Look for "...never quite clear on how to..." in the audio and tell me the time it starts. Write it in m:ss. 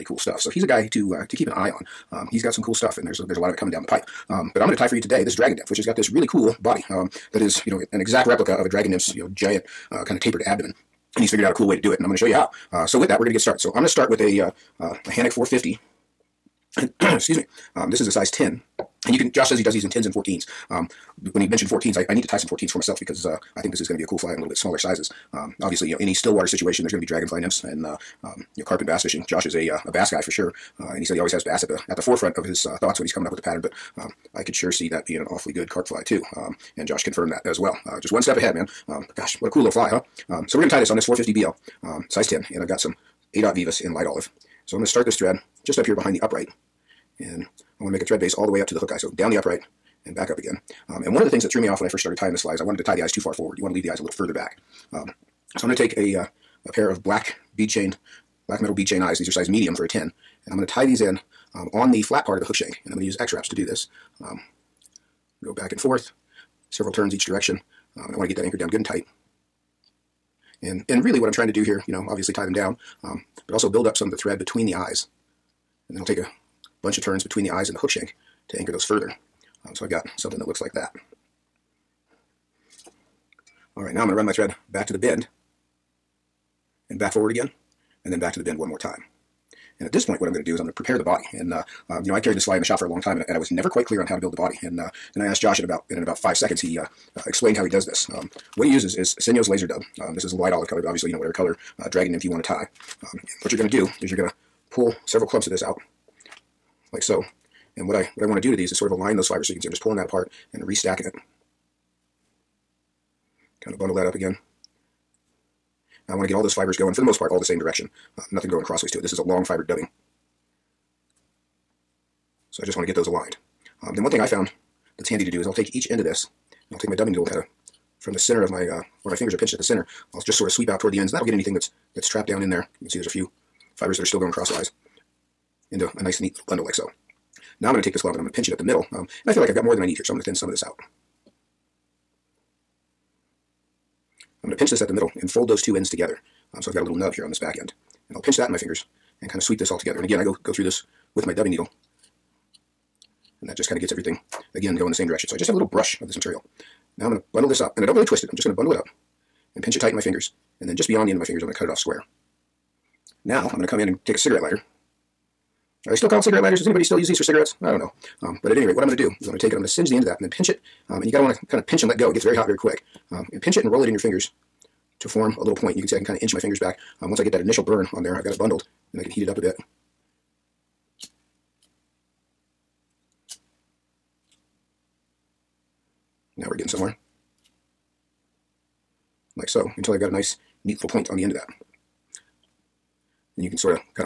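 1:33.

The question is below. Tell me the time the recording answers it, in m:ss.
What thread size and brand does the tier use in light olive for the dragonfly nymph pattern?
0:43.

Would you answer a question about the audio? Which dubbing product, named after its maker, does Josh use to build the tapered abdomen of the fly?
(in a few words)
Senyo's Laser Dub.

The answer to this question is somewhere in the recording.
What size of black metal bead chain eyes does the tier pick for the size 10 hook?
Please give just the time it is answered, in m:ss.
0:59.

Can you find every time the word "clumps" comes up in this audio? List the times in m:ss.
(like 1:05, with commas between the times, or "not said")
1:45, 2:18.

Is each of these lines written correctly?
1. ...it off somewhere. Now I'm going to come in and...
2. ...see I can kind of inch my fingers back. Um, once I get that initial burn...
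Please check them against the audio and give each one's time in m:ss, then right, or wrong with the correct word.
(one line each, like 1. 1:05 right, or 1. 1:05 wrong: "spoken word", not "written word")
1. 2:41 wrong: "square", not "somewhere"
2. 2:55 right.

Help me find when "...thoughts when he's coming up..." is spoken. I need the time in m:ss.
0:32.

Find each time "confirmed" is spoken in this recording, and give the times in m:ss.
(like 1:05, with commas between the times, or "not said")
0:37.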